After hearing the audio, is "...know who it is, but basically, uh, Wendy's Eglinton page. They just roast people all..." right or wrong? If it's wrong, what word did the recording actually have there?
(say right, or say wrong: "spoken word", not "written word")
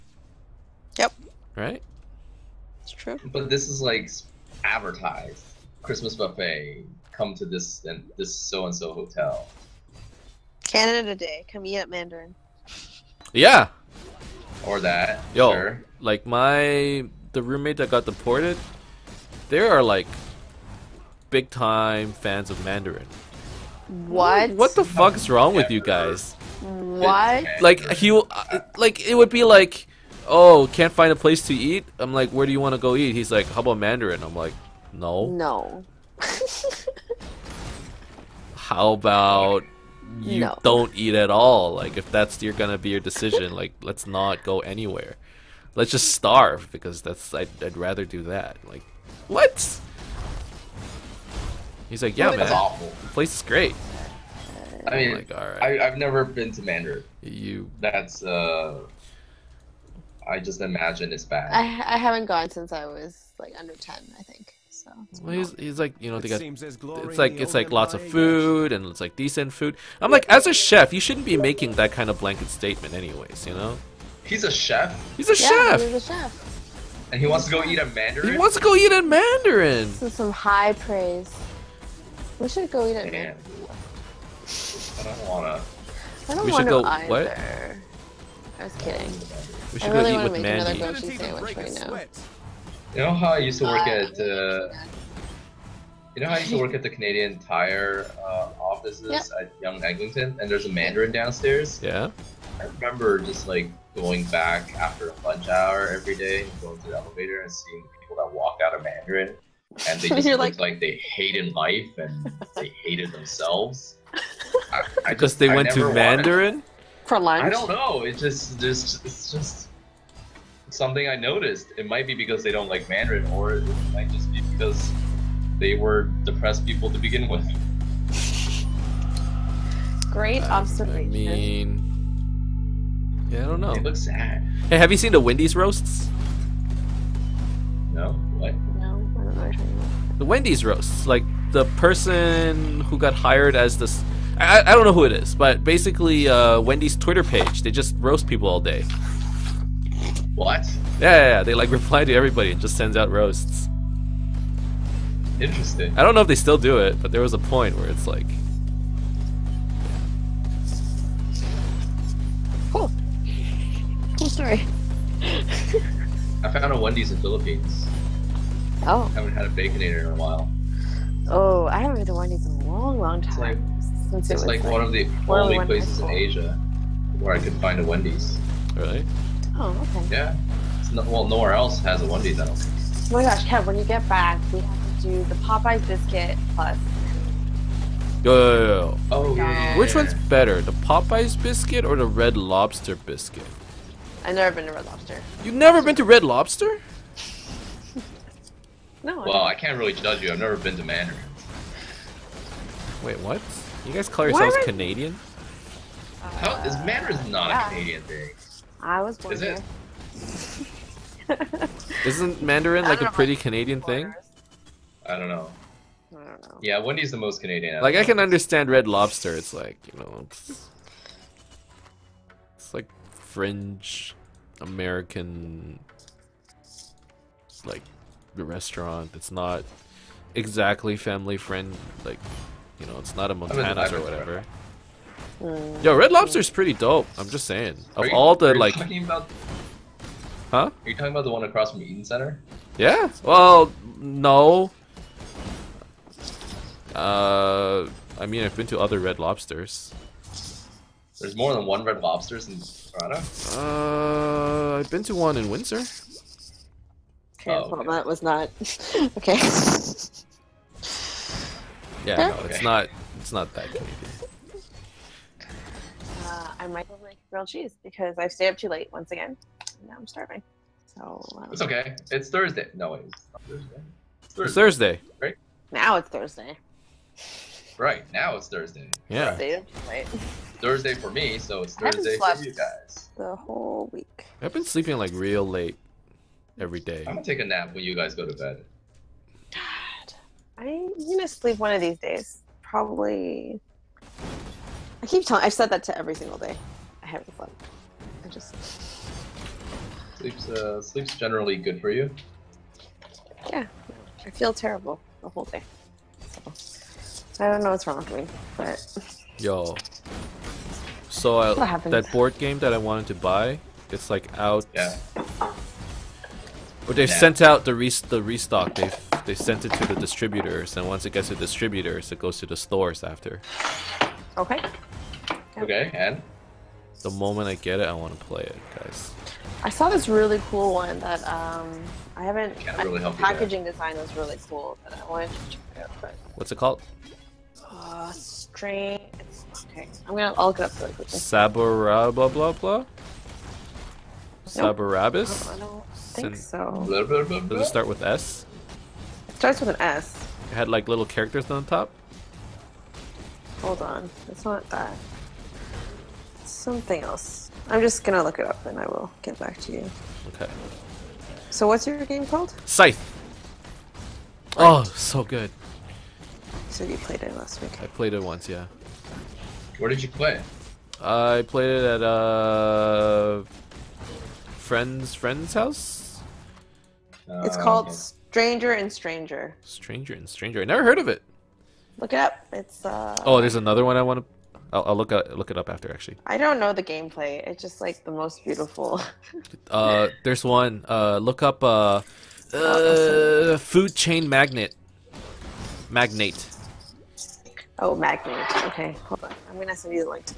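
wrong: "Twitter", not "Eglinton".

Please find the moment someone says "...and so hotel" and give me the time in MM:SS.
00:08.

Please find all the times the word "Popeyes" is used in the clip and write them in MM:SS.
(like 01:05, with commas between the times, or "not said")
03:05, 03:10.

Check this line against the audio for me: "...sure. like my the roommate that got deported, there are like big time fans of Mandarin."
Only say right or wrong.
right.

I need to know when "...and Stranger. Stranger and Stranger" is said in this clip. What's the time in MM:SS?
06:18.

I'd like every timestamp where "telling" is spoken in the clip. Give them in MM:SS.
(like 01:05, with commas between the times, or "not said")
04:55.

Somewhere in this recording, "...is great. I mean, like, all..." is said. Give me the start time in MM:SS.
00:53.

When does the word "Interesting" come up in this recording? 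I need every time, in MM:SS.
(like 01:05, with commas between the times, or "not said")
02:35.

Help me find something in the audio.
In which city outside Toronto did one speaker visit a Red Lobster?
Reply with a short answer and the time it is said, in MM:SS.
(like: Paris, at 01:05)
Windsor, at 04:15.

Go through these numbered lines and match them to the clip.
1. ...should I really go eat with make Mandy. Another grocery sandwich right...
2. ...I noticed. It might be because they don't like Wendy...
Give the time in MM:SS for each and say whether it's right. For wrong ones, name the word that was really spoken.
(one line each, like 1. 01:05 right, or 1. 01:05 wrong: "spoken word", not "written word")
1. 01:29 right
2. 02:01 wrong: "Mandarin", not "Wendy".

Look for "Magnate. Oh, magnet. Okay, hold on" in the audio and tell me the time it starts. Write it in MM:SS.
06:35.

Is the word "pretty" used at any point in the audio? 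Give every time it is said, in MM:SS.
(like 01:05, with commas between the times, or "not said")
03:33, 03:56.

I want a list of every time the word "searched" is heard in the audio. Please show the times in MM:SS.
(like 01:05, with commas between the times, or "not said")
not said.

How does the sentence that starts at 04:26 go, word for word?
Uh, I might have like grilled cheese because I stayed up too late once again.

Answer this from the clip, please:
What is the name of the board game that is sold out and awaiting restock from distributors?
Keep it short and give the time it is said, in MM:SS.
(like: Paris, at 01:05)
Scythe, at 06:02.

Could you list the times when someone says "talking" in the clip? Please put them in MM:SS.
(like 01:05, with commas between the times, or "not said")
02:19, 04:00.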